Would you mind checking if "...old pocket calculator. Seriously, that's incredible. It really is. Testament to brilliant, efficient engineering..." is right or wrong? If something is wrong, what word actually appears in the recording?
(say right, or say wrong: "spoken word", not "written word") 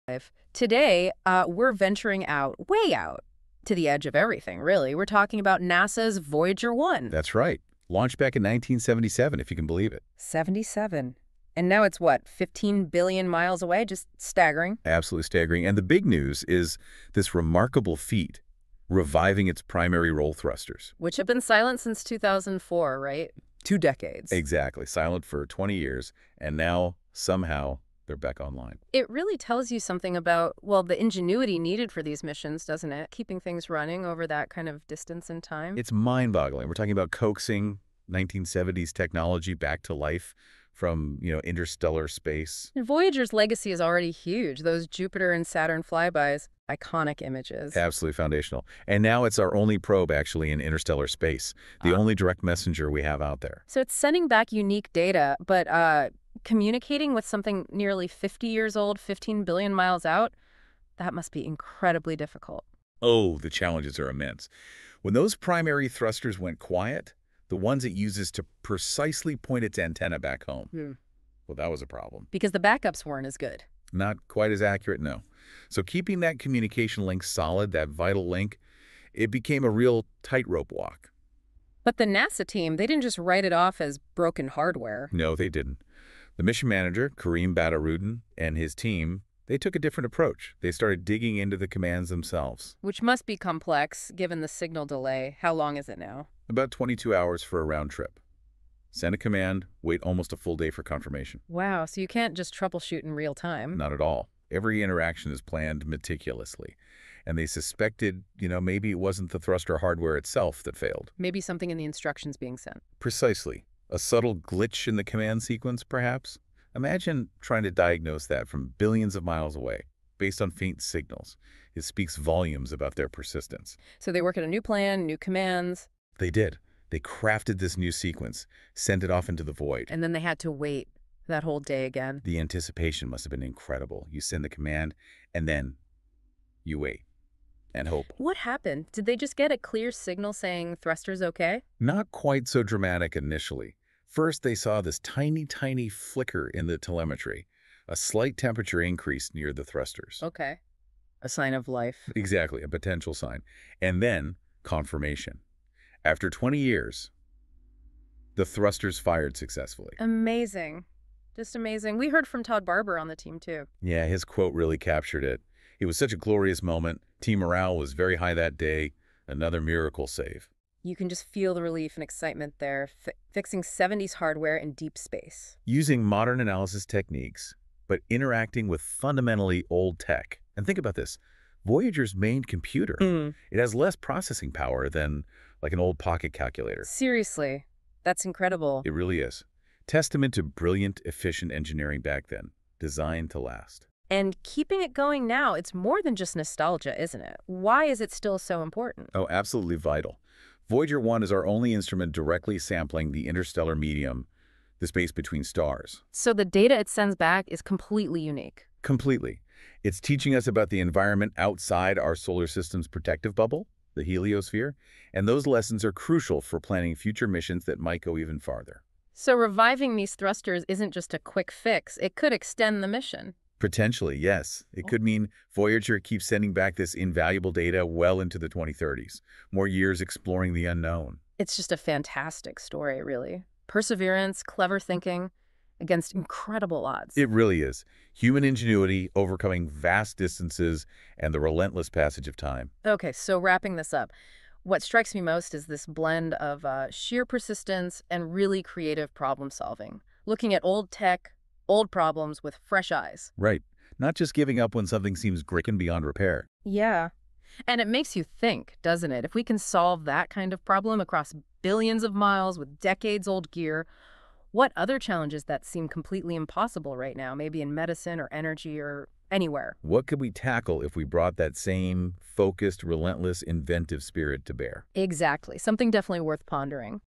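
right.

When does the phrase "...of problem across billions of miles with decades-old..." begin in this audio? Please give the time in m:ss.
4:20.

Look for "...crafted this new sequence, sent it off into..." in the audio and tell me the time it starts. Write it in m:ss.
2:07.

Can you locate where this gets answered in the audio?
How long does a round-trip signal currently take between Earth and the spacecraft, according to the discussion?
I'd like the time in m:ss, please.
1:36.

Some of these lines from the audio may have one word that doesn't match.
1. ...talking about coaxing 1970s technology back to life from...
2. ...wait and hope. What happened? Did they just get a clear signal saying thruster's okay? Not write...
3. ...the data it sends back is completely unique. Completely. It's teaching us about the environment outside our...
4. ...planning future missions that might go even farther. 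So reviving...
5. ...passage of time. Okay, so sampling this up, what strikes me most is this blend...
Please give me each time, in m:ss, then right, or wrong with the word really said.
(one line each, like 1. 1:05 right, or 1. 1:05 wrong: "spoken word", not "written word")
1. 0:36 right
2. 2:16 wrong: "quite", not "write"
3. 3:26 right
4. 3:36 right
5. 4:01 wrong: "wrapping", not "sampling".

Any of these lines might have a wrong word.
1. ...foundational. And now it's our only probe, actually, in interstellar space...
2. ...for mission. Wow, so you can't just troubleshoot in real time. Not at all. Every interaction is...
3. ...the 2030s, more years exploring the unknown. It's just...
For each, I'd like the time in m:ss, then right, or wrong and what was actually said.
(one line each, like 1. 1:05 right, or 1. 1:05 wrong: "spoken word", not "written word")
1. 0:48 right
2. 1:40 wrong: "confirmation", not "mission"
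3. 3:48 right.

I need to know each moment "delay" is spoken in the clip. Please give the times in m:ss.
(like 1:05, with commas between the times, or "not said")
1:34.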